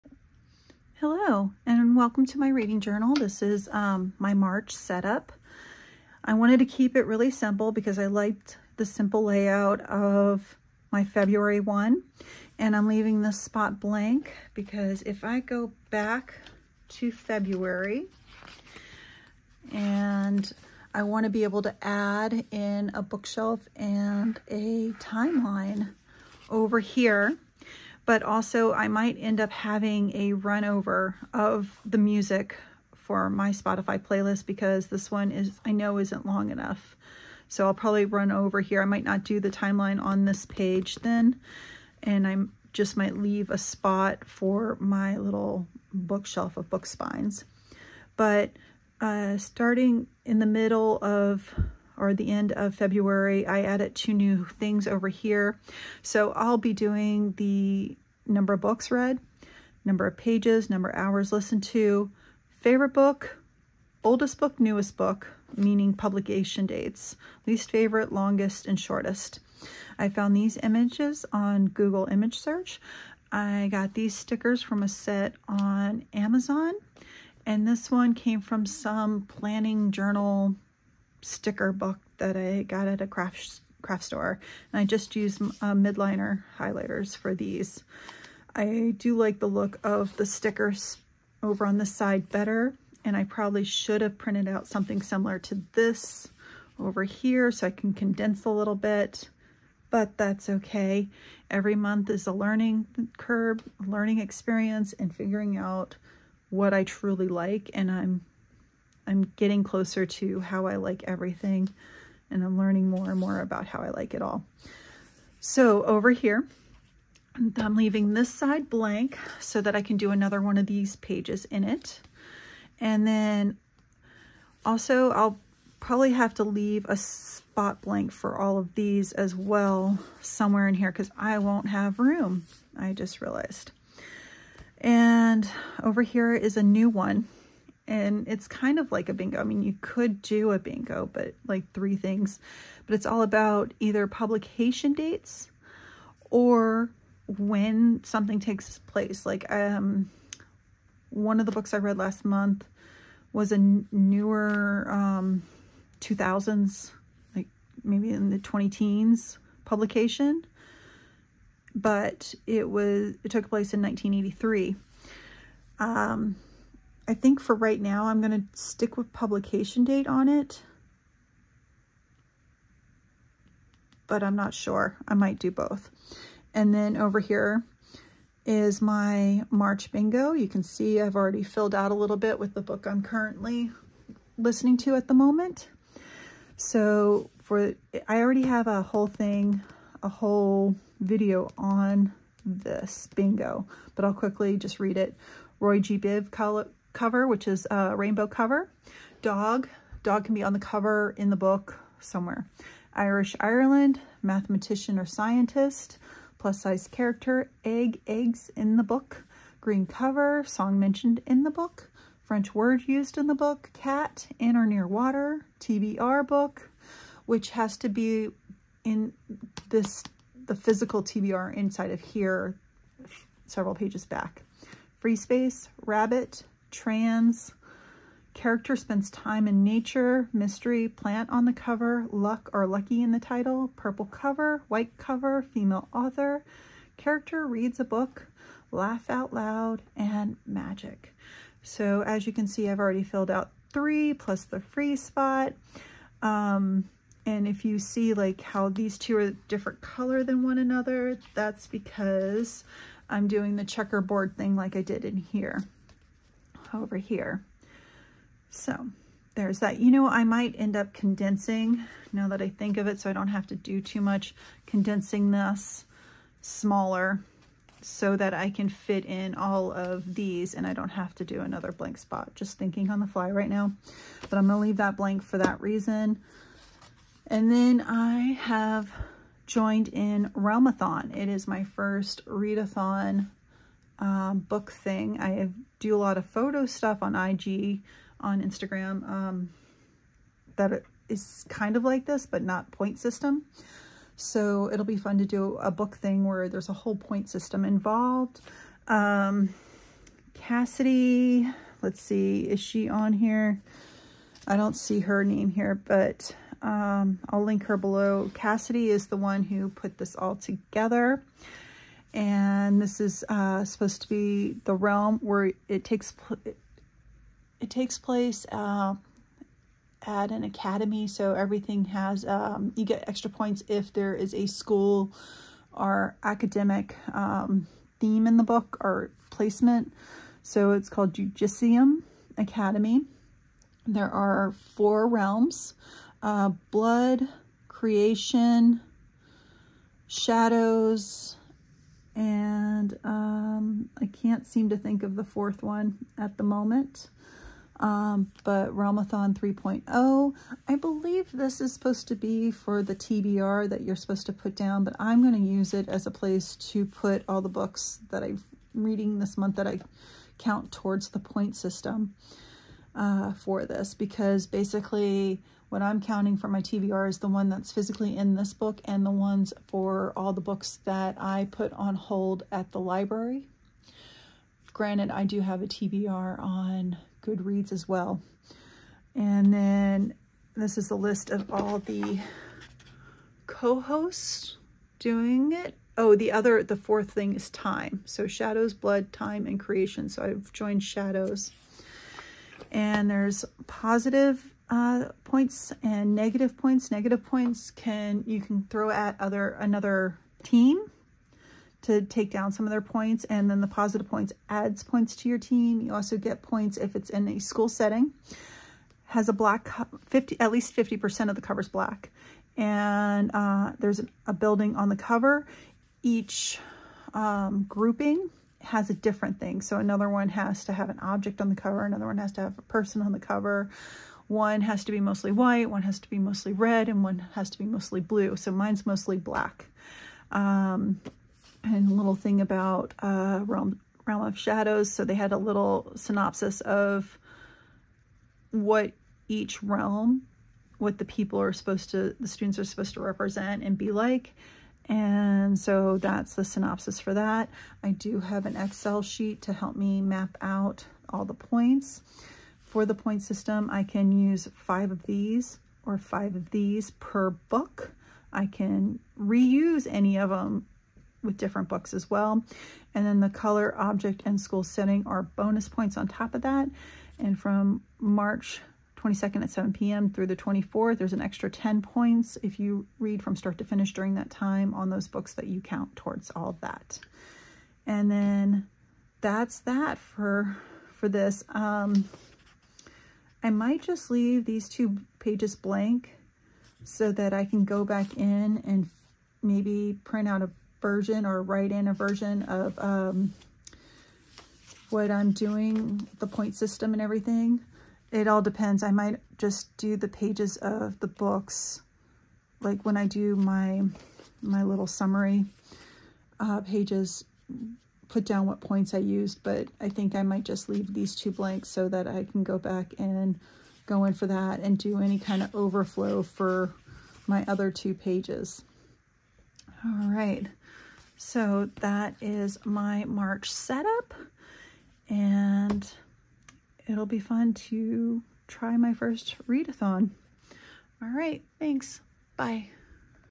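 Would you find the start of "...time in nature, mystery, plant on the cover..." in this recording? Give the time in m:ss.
3:49.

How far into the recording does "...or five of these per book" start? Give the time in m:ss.
7:35.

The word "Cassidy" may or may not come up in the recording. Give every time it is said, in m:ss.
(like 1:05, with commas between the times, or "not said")
5:00, 5:08.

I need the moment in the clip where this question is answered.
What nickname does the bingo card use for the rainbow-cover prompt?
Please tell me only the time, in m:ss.
3:15.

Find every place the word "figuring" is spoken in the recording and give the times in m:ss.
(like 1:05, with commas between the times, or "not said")
1:45.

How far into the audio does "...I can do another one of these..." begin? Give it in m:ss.
1:59.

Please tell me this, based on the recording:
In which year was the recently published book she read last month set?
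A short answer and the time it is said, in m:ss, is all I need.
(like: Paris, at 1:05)
1983, at 2:43.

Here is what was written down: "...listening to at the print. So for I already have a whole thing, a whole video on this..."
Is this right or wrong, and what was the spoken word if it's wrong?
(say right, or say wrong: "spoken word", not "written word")
wrong: "moment", not "print".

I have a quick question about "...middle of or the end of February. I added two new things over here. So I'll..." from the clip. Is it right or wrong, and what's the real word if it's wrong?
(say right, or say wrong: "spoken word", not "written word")
right.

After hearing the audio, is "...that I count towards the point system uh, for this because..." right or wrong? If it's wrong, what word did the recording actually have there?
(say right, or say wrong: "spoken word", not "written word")
right.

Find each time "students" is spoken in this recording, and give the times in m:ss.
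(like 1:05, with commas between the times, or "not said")
7:22.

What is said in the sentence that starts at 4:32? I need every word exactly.
Just thinking on the fly right now.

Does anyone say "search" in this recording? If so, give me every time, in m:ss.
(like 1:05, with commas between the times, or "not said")
1:12.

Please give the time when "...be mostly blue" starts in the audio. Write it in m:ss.
7:07.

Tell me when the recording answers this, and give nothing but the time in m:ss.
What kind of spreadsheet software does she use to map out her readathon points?
7:28.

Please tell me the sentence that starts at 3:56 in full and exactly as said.
Character reads a book, laugh out loud, and magic.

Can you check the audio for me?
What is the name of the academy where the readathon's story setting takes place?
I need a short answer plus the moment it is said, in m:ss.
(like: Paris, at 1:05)
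Judicium Academy, at 5:31.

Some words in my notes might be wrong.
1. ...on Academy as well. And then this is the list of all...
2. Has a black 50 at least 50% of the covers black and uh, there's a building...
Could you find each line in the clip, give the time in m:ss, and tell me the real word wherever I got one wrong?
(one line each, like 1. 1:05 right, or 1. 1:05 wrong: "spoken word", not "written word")
1. 6:16 wrong: "Goodreads", not "Academy"
2. 6:49 right.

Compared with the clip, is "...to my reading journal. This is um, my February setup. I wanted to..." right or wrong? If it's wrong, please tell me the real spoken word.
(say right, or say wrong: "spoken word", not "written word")
wrong: "March", not "February".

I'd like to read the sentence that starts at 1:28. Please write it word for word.
I do like the look of the stickers over on the side better.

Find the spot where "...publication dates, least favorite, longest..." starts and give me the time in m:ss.
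1:05.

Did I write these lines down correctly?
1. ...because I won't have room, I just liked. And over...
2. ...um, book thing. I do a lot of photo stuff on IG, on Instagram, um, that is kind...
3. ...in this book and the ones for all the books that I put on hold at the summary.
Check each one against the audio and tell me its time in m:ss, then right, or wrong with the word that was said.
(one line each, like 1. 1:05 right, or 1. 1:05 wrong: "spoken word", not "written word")
1. 2:10 wrong: "realized", not "liked"
2. 4:44 right
3. 6:08 wrong: "library", not "summary".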